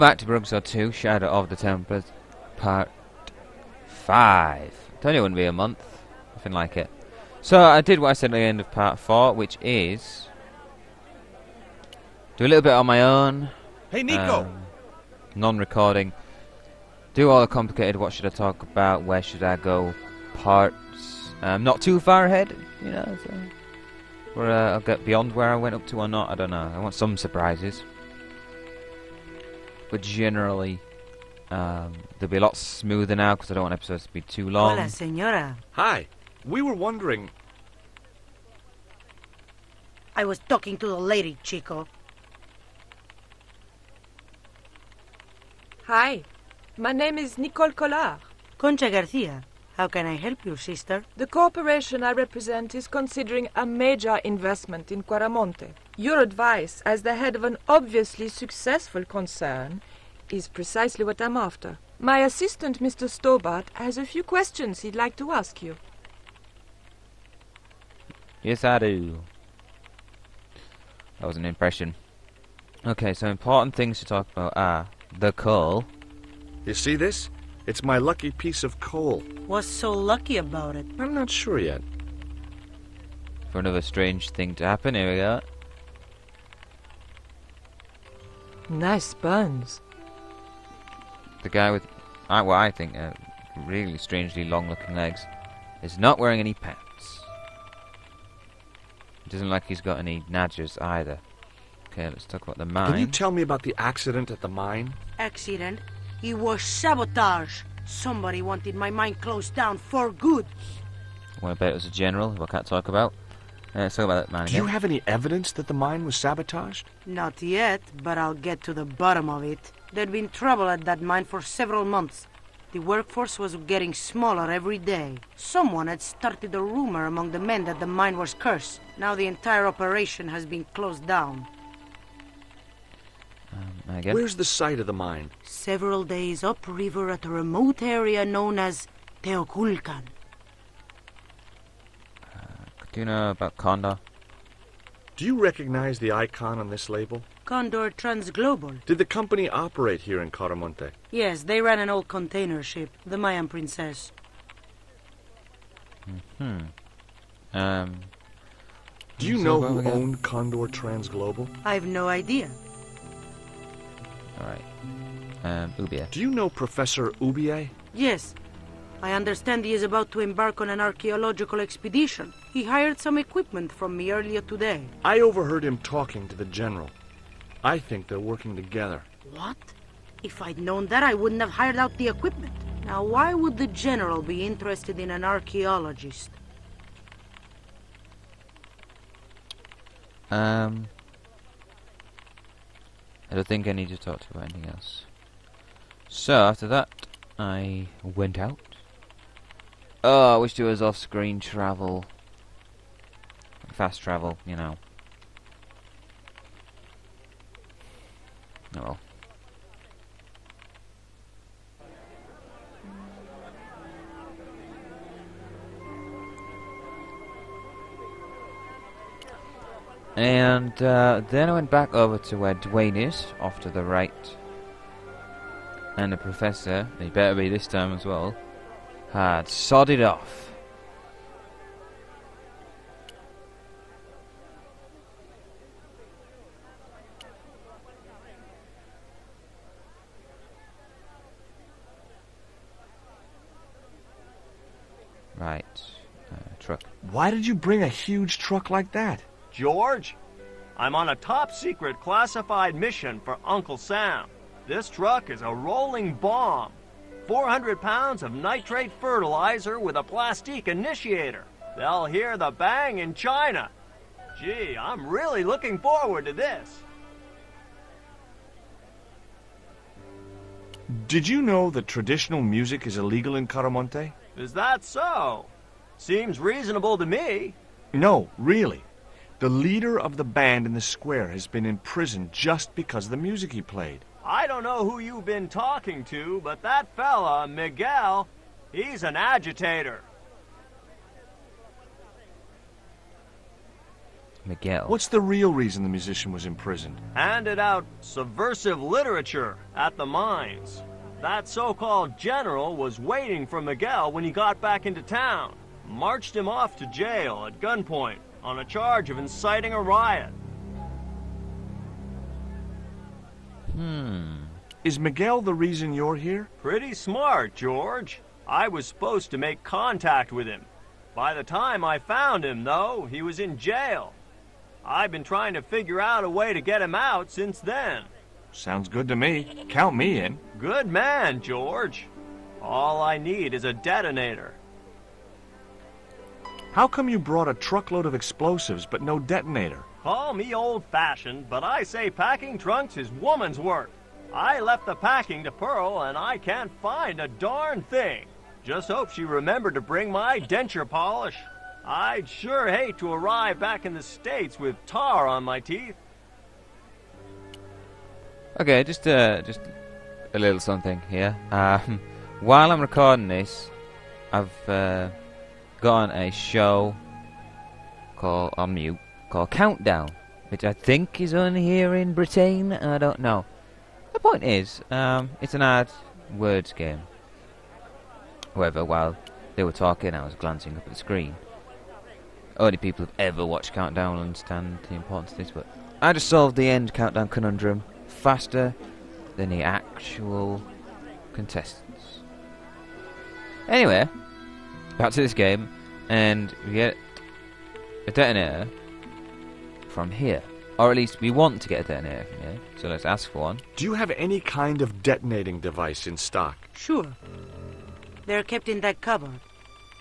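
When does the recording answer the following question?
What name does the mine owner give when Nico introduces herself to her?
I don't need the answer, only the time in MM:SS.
00:48.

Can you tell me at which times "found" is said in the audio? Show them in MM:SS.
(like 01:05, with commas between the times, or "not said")
05:21.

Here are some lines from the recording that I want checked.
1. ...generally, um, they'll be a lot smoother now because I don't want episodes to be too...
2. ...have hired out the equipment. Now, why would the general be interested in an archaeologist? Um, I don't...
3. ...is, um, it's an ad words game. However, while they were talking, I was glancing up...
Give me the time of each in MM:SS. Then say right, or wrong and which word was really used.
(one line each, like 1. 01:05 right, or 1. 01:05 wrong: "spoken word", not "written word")
1. 00:30 right
2. 03:01 right
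3. 06:14 right.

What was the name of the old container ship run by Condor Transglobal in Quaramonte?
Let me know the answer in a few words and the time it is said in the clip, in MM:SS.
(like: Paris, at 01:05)
Mayan Princess, at 02:33.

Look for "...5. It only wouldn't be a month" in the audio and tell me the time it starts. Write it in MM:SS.
00:03.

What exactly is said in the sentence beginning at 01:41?
Okay, let's talk about the mine.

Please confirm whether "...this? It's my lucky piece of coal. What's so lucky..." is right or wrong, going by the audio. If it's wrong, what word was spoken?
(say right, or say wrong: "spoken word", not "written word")
right.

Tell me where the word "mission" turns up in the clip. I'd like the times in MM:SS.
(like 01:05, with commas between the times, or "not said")
04:12.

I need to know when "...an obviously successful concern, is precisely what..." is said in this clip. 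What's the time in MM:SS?
00:57.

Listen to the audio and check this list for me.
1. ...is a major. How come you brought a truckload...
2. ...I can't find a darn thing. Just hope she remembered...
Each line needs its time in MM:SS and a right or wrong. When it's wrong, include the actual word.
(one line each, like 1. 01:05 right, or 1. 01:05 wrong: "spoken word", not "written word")
1. 05:33 wrong: "detonator", not "major"
2. 05:46 right.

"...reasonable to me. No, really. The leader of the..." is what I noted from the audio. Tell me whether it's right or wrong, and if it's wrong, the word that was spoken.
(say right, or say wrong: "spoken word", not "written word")
right.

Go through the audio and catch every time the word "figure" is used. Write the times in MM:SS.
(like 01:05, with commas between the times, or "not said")
05:25.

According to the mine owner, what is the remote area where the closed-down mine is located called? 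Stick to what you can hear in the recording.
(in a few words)
Teoculcan.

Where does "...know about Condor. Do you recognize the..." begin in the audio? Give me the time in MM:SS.
02:23.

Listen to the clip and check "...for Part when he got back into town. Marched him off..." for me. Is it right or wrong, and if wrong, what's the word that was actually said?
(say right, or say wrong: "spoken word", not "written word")
wrong: "Miguel", not "Part".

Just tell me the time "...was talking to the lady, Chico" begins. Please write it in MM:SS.
00:40.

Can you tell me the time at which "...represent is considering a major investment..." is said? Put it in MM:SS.
00:52.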